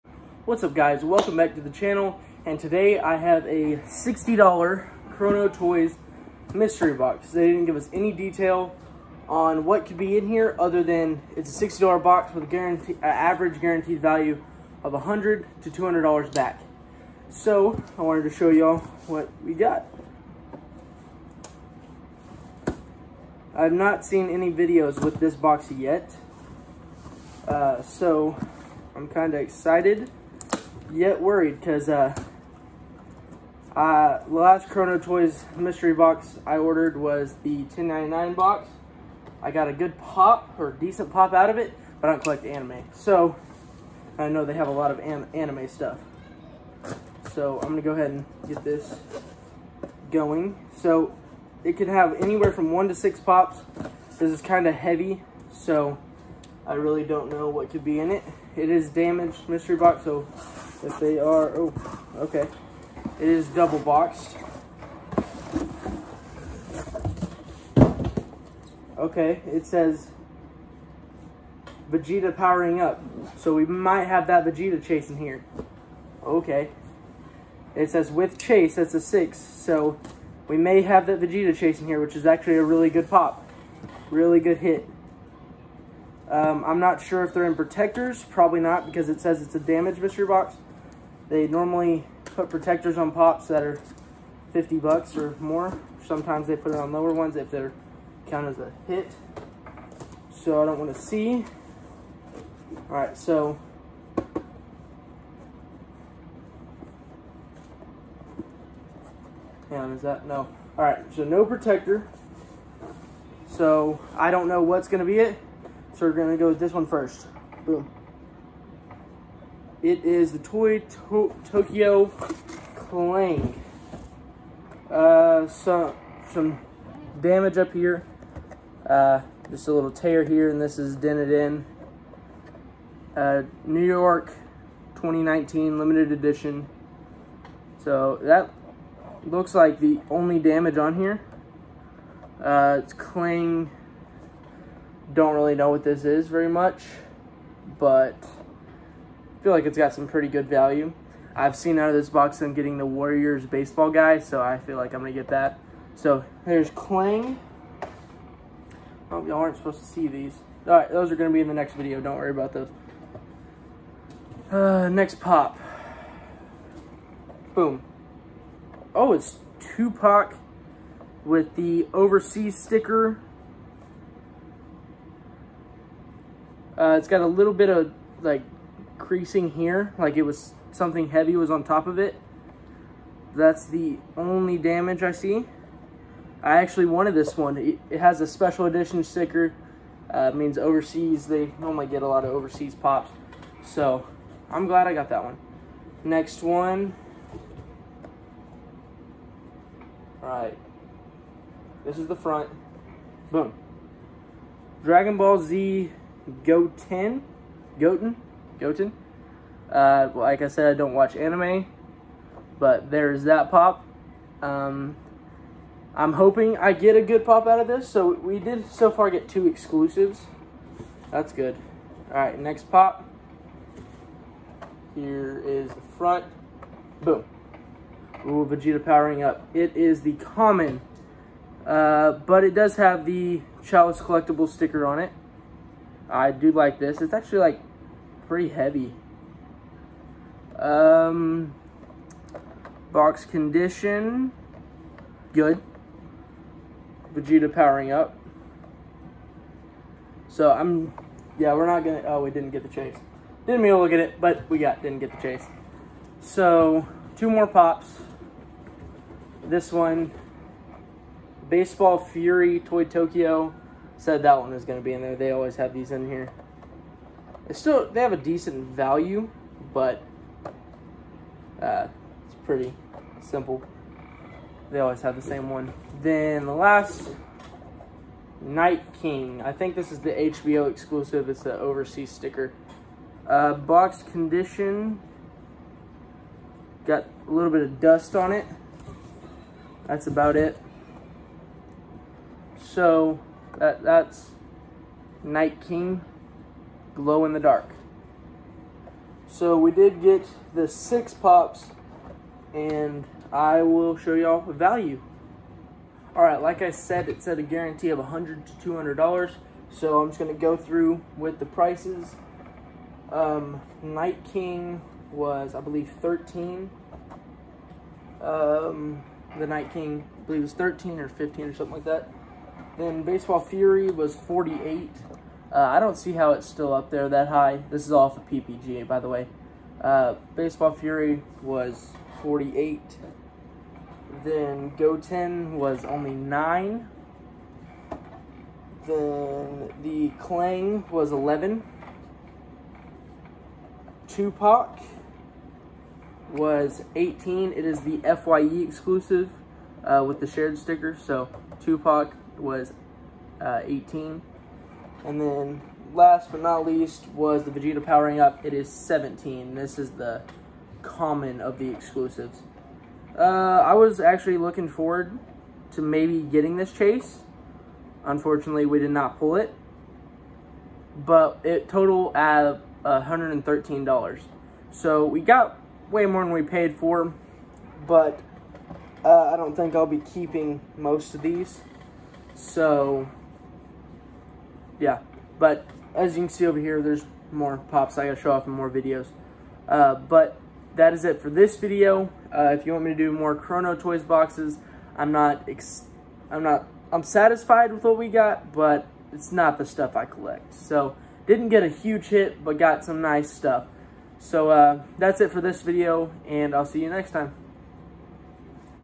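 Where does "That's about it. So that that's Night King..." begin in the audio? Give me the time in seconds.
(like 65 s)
289 s.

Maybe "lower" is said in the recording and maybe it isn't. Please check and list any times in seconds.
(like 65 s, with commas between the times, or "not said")
96 s.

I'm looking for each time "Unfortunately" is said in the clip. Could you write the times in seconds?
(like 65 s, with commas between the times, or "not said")
368 s.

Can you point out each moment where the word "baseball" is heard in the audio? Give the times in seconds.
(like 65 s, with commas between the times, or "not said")
153 s, 261 s, 323 s, 330 s.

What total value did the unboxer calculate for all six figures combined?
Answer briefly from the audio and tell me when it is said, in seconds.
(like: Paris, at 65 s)
$113, at 372 s.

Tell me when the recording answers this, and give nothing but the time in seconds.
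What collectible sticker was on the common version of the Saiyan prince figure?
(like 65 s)
233 s.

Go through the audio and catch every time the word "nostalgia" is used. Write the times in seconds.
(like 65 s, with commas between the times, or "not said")
not said.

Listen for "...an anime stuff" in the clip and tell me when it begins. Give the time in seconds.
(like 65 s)
44 s.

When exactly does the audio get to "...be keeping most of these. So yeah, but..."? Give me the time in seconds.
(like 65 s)
379 s.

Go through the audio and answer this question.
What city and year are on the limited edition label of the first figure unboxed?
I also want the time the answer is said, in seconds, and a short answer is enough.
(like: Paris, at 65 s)
New York 2019, at 133 s.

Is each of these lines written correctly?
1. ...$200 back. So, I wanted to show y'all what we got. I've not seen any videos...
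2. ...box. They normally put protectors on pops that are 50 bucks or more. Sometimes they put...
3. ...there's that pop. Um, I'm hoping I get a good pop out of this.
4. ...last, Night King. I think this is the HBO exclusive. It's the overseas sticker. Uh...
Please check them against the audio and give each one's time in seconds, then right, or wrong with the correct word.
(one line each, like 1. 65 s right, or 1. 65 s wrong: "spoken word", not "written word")
1. 15 s right
2. 90 s right
3. 212 s right
4. 276 s right.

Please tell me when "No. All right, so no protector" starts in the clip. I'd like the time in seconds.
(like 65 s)
110 s.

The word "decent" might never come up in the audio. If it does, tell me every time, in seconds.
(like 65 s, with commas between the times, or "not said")
40 s, 268 s.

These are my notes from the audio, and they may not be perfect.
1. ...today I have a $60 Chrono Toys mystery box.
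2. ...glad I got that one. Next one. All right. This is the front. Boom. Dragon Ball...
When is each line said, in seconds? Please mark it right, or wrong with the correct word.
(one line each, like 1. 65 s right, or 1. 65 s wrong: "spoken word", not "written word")
1. 2 s right
2. 194 s right.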